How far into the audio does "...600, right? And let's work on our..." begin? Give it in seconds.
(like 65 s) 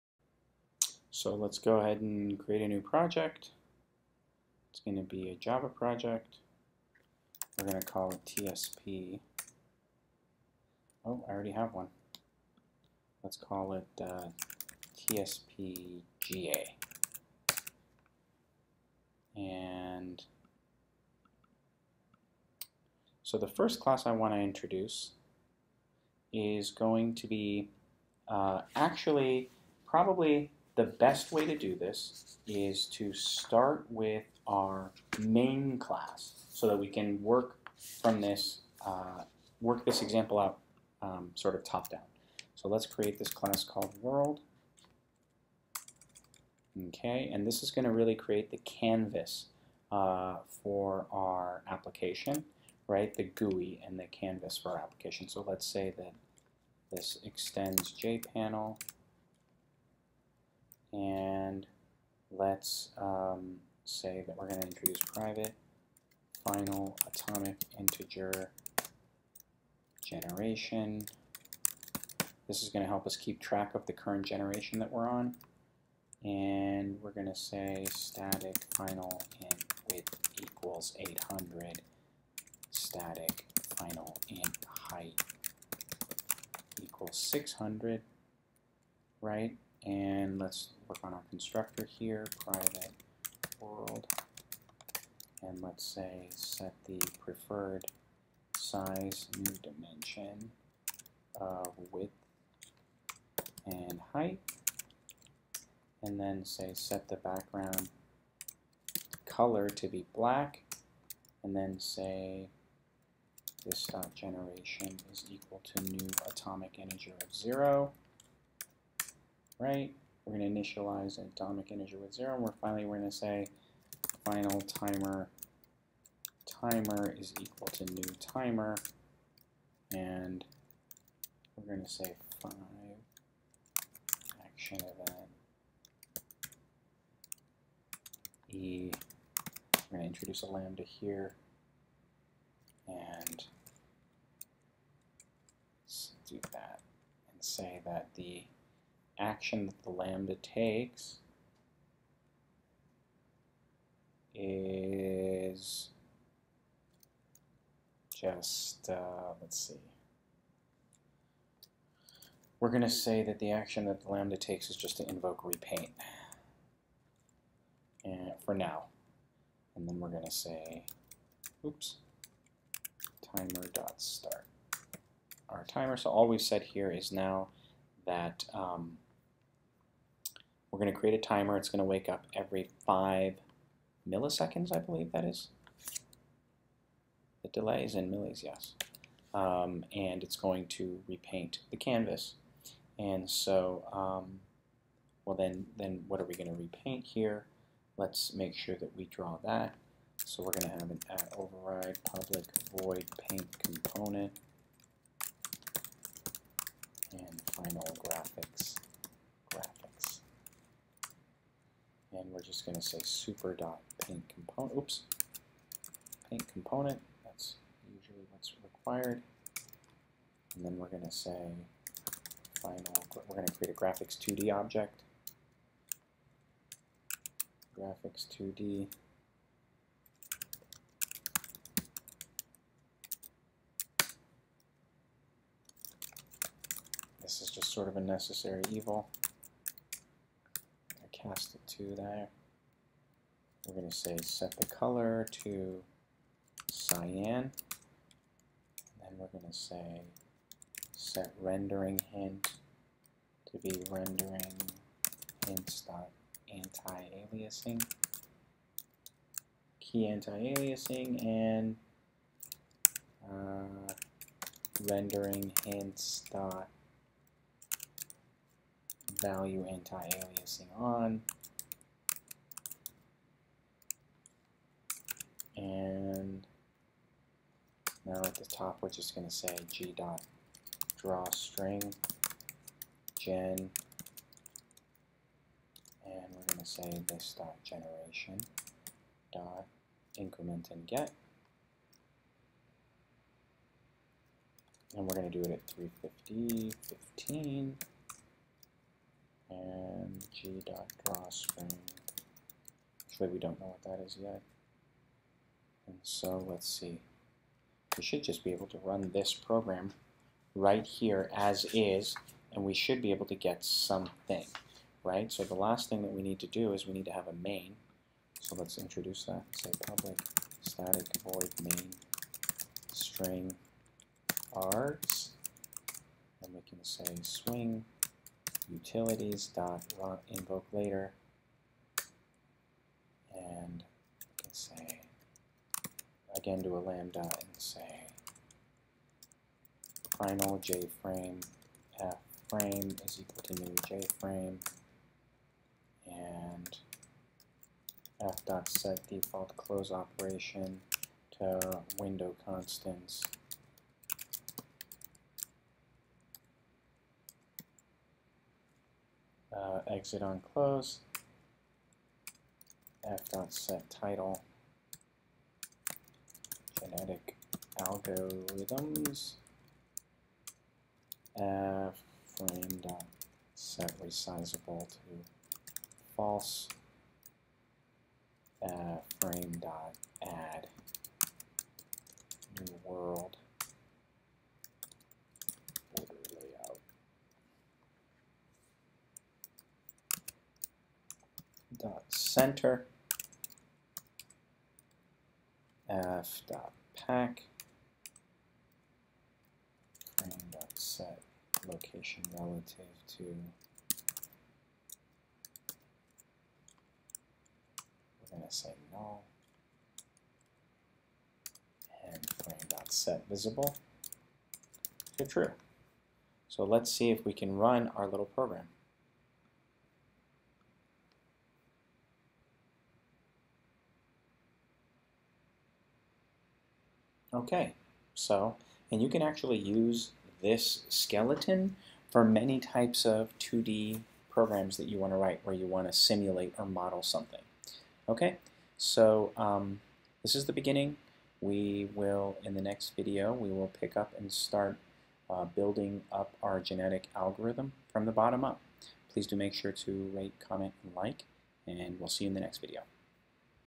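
87 s.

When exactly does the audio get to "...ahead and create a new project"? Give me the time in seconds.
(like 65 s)
1 s.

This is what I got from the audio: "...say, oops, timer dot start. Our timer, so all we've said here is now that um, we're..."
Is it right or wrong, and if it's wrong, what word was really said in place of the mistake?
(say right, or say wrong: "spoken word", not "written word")
right.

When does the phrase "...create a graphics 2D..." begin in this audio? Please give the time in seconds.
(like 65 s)
223 s.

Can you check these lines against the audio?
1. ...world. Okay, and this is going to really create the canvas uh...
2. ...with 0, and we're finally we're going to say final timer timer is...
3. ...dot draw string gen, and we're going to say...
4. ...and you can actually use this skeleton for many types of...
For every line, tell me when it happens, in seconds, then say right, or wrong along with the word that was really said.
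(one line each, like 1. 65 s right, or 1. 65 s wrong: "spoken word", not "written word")
1. 44 s right
2. 121 s right
3. 279 s right
4. 428 s right.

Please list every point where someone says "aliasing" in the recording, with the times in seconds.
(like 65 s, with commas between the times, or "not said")
255 s, 260 s, 269 s.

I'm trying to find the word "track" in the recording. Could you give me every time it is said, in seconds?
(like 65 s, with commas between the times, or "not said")
73 s.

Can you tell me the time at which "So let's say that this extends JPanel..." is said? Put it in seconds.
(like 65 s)
55 s.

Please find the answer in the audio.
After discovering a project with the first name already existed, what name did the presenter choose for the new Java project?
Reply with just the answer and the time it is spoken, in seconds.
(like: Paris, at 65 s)
TSPGA, at 15 s.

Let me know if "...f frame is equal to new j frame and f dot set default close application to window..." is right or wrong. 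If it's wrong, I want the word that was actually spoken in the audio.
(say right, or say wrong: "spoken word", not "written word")
wrong: "operation", not "application".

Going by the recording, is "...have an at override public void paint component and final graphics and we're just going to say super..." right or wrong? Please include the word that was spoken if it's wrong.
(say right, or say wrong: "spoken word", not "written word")
right.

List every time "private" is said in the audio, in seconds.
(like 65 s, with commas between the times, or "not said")
65 s, 92 s.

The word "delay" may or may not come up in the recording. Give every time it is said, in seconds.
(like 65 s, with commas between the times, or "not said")
187 s.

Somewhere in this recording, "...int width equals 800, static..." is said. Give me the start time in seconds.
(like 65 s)
79 s.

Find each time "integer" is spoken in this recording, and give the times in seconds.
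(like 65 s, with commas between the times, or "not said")
67 s, 116 s, 121 s.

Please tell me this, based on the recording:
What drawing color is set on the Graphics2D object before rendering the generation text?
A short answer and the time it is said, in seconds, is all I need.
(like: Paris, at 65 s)
cyan, at 246 s.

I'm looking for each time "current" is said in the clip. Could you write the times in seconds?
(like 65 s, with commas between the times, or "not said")
73 s.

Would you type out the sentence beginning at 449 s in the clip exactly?
Please do make sure to rate, comment, and like, and we'll see you in the next video.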